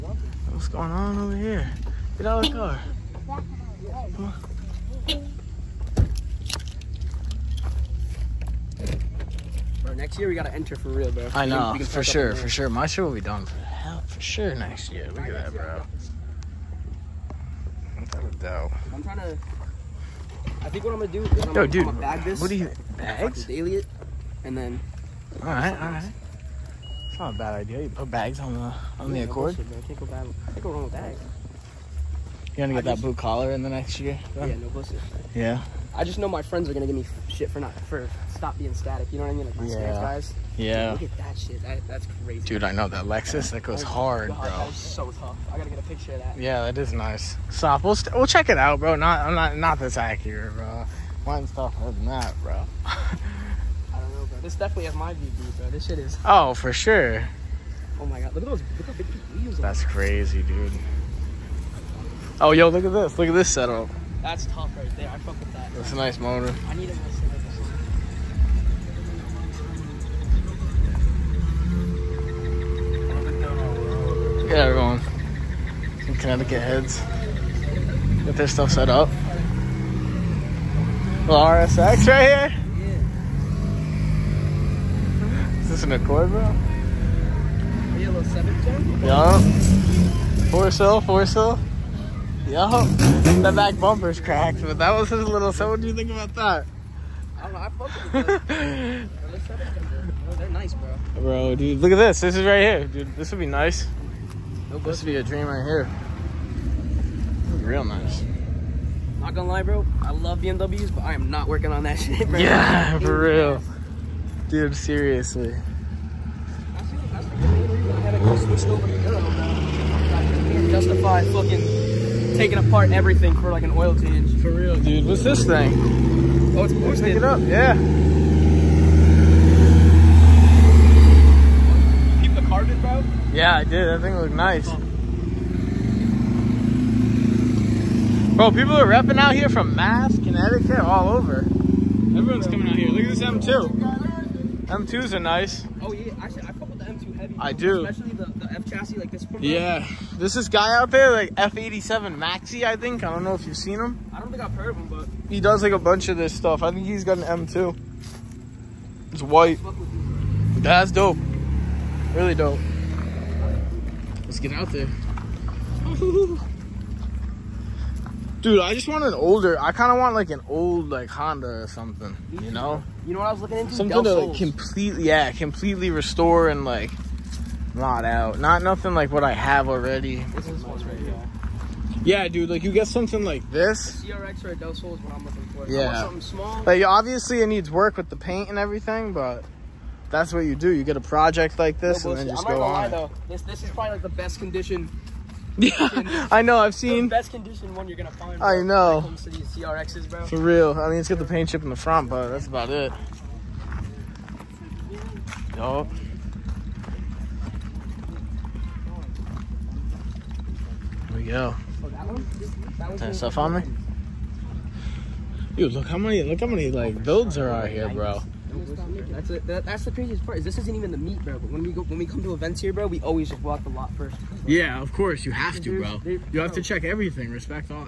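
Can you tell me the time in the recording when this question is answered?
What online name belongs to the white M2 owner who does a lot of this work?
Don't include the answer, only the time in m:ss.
2:31.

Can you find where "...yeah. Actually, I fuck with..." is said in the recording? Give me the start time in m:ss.
2:25.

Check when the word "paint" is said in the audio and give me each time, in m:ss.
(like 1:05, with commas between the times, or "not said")
3:08, 3:21.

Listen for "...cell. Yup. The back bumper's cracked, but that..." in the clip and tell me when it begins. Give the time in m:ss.
1:31.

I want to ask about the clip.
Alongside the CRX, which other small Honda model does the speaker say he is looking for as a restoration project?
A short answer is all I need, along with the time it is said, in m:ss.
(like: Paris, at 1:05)
Del Sol, at 3:04.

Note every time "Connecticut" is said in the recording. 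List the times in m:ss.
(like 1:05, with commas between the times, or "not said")
1:16, 2:20.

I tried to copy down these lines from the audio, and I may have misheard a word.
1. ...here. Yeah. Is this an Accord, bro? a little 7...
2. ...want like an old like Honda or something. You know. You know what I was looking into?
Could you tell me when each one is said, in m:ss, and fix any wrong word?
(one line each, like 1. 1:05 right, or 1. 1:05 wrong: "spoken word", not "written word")
1. 1:22 right
2. 2:49 right.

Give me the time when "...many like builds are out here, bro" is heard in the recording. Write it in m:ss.
3:36.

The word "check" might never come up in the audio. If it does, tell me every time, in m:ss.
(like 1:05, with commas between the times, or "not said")
0:48, 3:46.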